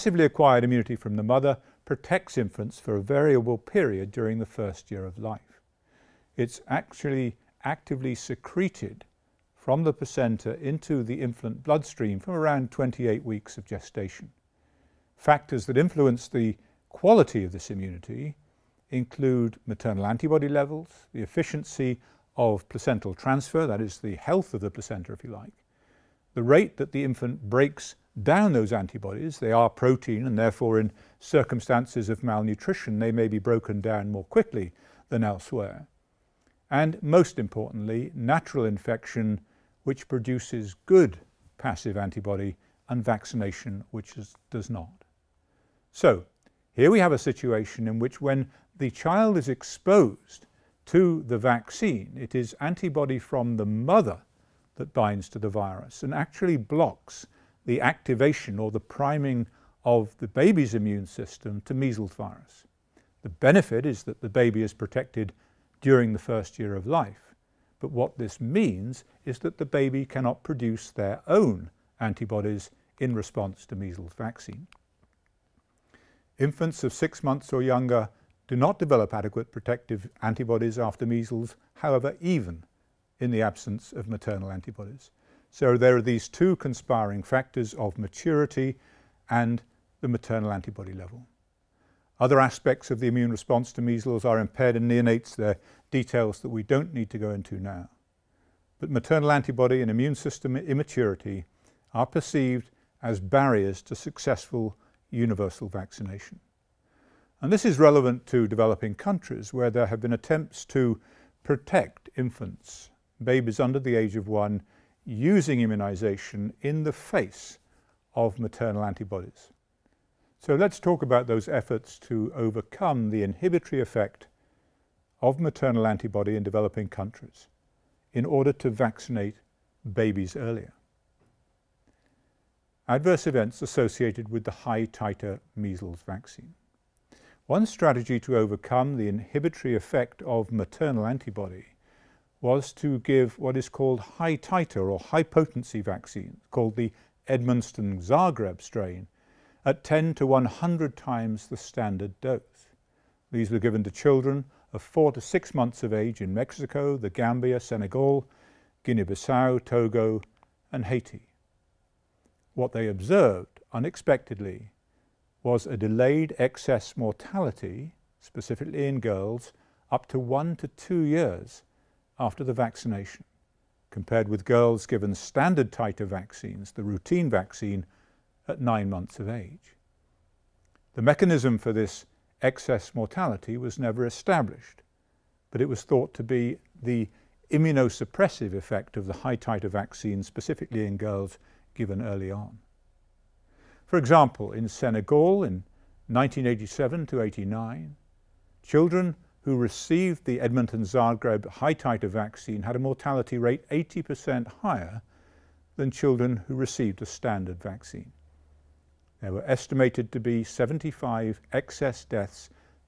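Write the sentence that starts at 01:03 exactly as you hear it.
The benefit is that the baby is protected during the first year of life.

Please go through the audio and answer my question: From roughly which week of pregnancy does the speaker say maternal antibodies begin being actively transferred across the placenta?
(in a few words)
28 weeks.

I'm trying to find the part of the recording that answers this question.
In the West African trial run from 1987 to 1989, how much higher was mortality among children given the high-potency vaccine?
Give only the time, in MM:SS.
03:23.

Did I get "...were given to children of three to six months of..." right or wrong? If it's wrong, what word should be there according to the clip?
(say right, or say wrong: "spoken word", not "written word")
wrong: "four", not "three".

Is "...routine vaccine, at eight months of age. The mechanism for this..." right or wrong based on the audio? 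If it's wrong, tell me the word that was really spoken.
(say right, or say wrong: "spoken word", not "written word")
wrong: "nine", not "eight".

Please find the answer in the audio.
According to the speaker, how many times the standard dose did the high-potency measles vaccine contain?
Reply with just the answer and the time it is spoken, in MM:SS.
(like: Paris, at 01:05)
10 to 100, at 02:29.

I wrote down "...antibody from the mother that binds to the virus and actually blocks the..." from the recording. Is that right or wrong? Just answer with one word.
right.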